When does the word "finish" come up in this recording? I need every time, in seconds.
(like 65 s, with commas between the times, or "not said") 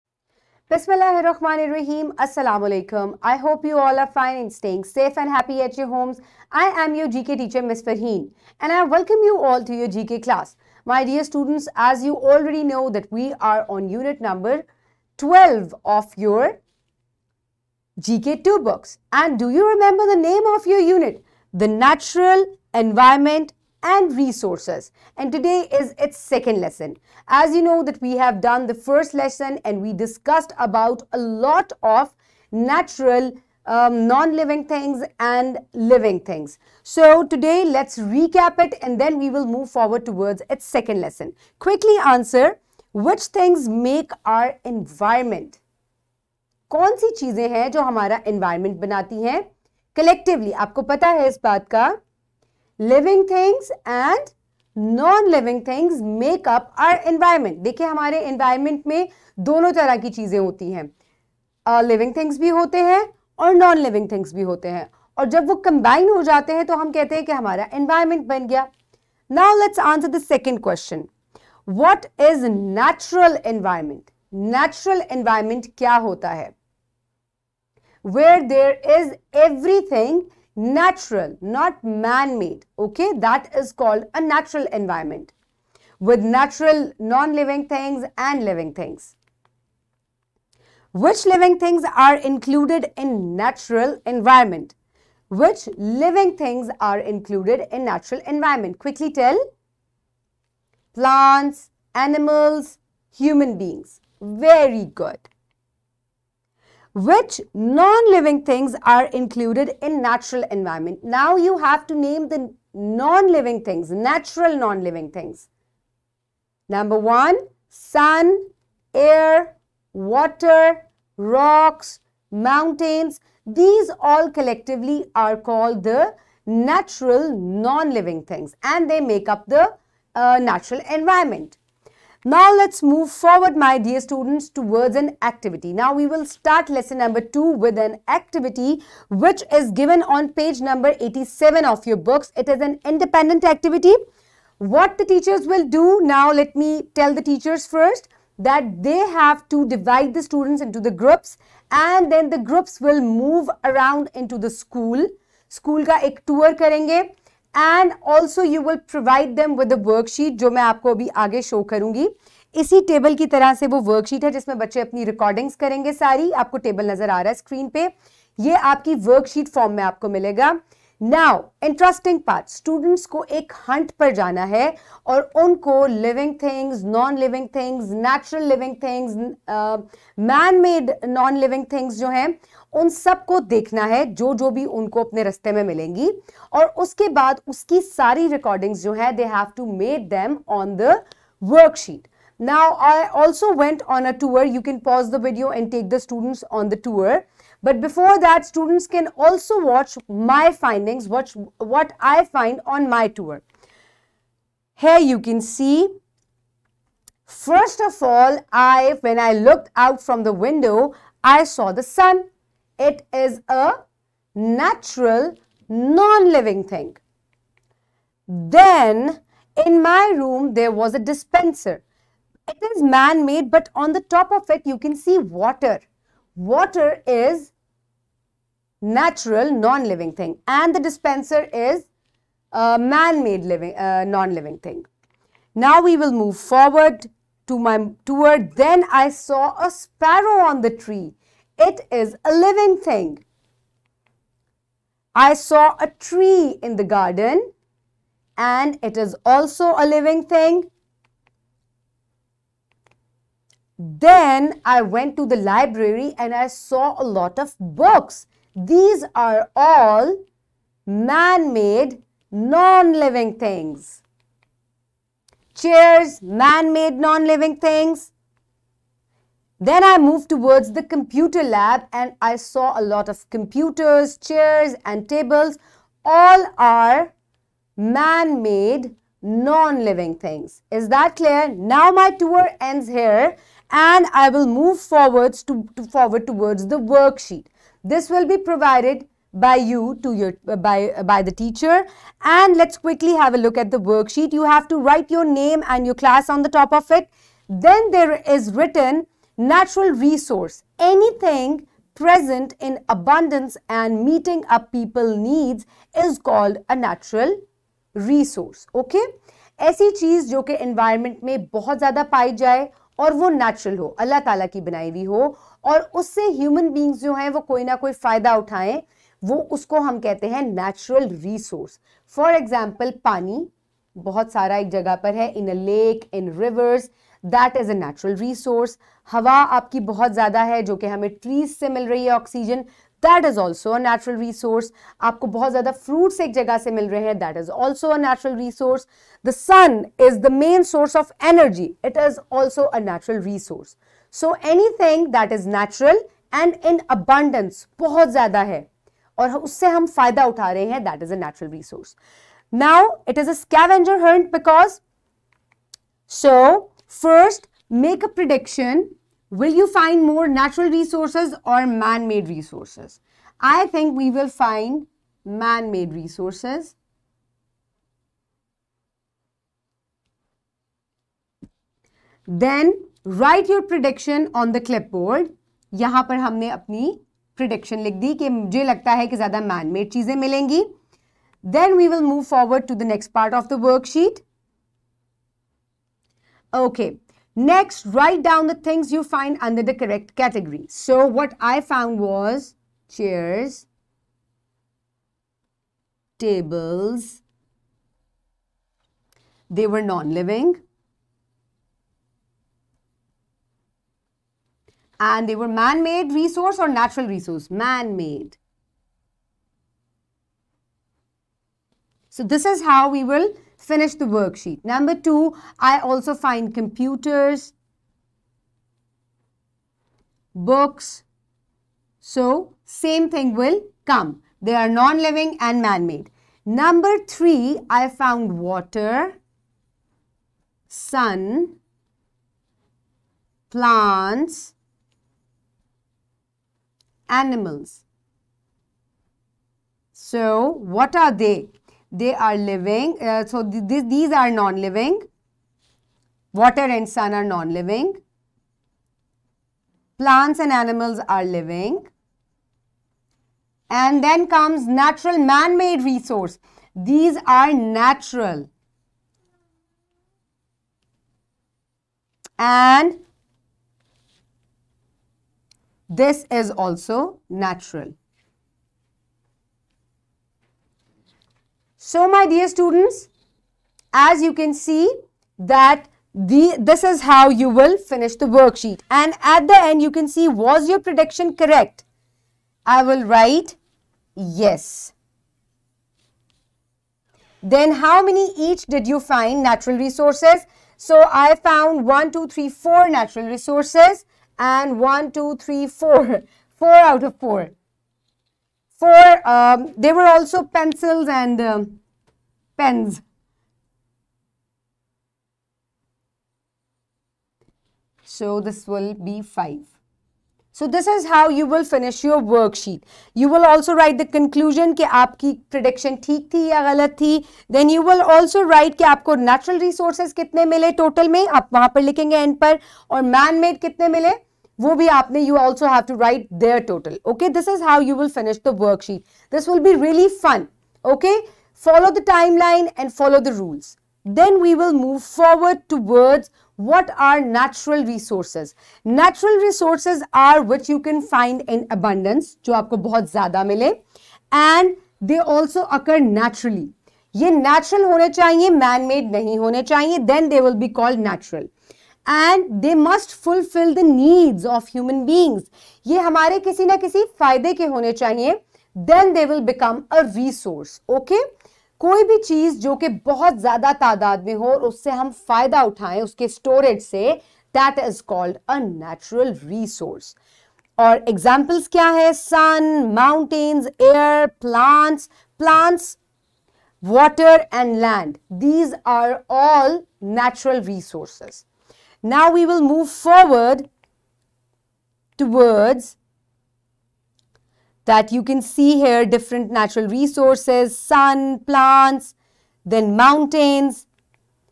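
413 s, 477 s, 511 s.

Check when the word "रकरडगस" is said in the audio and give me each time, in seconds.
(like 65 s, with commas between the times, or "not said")
165 s, 188 s.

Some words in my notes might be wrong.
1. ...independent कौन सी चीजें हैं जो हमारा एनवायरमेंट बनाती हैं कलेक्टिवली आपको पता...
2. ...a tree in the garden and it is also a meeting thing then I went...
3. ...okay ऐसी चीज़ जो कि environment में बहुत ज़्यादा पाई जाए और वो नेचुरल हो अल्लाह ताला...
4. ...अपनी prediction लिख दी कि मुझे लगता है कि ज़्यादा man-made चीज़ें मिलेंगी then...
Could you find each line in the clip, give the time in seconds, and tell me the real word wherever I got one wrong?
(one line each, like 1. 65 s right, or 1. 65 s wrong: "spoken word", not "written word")
1. 44 s wrong: "environment", not "independent"
2. 245 s wrong: "living", not "meeting"
3. 308 s right
4. 376 s right.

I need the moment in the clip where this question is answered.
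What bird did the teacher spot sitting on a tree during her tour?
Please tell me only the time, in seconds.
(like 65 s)
239 s.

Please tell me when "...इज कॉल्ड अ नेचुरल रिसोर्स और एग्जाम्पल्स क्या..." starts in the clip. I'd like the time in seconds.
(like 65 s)
567 s.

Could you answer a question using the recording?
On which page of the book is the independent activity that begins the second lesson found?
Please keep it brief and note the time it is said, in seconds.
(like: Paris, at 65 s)
87, at 141 s.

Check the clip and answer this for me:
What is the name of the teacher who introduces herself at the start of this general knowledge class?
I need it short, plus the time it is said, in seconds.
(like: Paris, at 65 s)
Ms. Farheen, at 7 s.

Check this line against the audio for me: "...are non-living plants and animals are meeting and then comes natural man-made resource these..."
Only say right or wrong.
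wrong.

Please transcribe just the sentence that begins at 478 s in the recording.
And at the end, you can see, was your prediction correct?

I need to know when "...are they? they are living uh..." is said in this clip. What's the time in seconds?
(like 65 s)
440 s.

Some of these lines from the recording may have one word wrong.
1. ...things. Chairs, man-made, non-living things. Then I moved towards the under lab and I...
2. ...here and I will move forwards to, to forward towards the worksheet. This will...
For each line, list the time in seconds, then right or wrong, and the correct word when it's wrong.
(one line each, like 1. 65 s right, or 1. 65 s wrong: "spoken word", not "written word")
1. 263 s wrong: "computer", not "under"
2. 282 s right.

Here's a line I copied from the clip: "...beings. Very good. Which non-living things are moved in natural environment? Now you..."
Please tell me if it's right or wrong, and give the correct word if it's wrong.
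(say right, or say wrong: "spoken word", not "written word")
wrong: "included", not "moved".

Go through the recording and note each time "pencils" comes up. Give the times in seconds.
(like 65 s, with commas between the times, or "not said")
500 s.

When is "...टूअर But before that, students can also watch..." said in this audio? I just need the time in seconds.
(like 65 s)
196 s.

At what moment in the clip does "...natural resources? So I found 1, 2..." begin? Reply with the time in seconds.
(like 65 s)
489 s.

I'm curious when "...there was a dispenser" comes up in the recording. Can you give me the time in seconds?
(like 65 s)
220 s.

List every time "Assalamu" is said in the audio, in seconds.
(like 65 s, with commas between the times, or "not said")
2 s.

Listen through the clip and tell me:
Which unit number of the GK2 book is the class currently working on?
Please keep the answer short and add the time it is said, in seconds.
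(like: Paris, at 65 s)
12, at 15 s.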